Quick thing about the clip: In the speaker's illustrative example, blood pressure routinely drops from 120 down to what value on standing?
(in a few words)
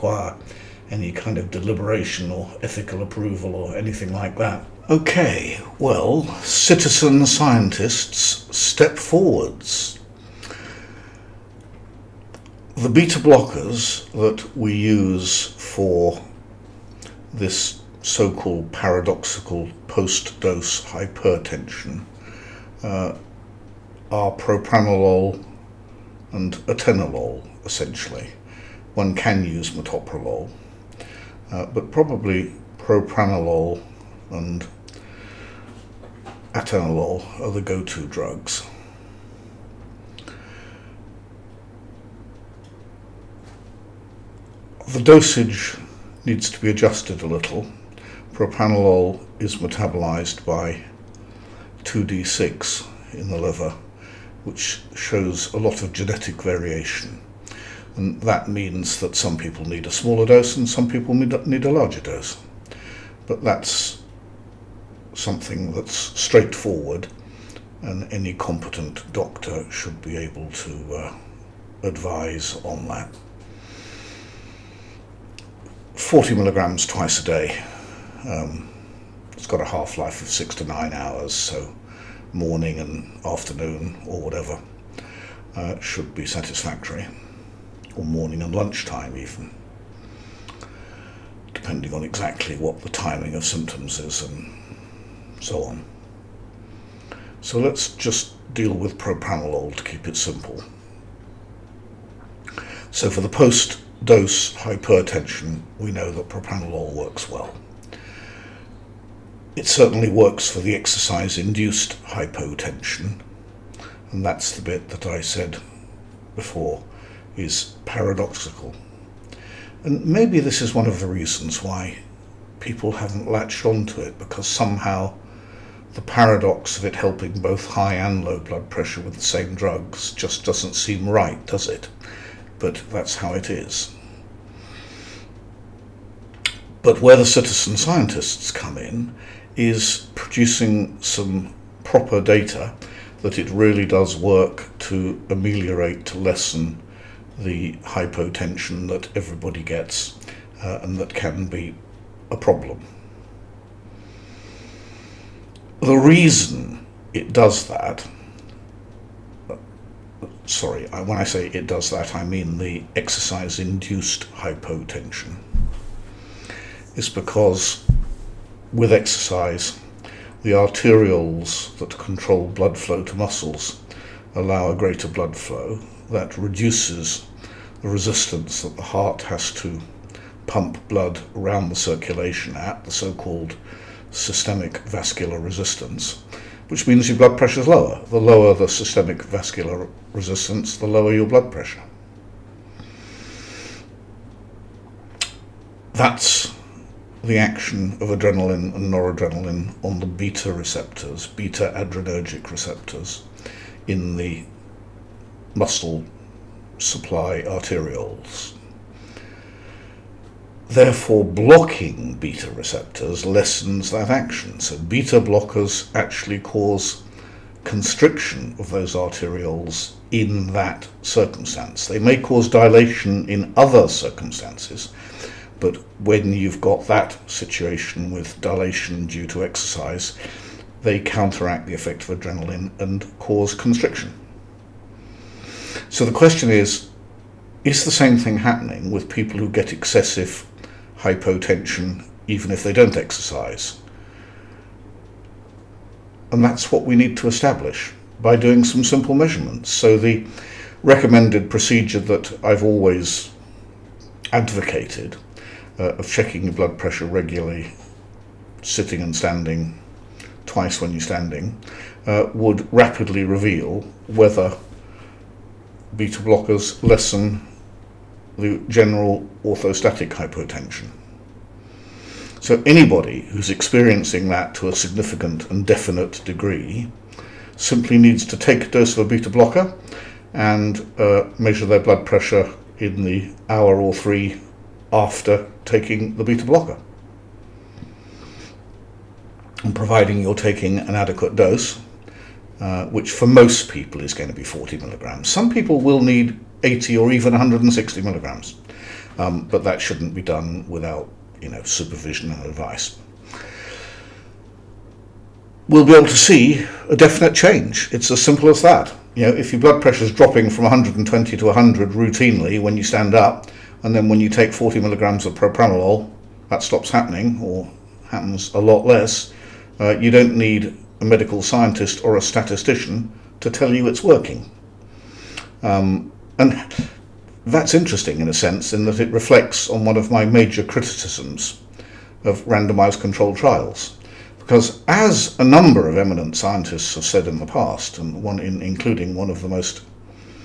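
100.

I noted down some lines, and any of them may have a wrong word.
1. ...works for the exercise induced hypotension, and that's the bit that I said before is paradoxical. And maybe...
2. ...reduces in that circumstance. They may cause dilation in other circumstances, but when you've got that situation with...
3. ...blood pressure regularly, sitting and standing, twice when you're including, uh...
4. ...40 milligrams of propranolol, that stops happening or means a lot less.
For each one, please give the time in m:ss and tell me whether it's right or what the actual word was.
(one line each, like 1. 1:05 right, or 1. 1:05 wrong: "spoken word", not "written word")
1. 1:50 right
2. 3:38 wrong: "arterioles", not "reduces"
3. 4:16 wrong: "standing", not "including"
4. 5:14 wrong: "happens", not "means".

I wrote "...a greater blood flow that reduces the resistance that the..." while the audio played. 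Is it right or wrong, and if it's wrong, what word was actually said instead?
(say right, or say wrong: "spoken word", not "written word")
right.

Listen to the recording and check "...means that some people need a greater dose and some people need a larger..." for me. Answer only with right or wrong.
wrong.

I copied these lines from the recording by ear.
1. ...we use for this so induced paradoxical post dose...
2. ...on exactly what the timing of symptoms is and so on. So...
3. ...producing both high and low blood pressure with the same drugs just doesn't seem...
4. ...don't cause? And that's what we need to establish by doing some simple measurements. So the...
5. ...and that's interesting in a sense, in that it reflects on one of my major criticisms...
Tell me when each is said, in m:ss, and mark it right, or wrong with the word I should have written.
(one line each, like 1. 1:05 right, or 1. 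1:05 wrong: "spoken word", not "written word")
1. 0:14 wrong: "called", not "induced"
2. 1:31 right
3. 2:06 wrong: "helping", not "producing"
4. 4:02 wrong: "exercise", not "cause"
5. 5:26 right.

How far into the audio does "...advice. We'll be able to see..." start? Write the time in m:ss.
5:02.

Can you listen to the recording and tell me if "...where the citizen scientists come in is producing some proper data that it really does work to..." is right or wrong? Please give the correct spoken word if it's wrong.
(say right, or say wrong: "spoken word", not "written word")
right.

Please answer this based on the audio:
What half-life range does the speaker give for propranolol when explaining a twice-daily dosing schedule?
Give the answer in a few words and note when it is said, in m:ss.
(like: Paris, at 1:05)
6 to 9 hours, at 1:20.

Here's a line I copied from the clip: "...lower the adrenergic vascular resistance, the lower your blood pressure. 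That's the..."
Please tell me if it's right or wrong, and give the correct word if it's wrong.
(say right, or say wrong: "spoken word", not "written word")
wrong: "systemic", not "adrenergic".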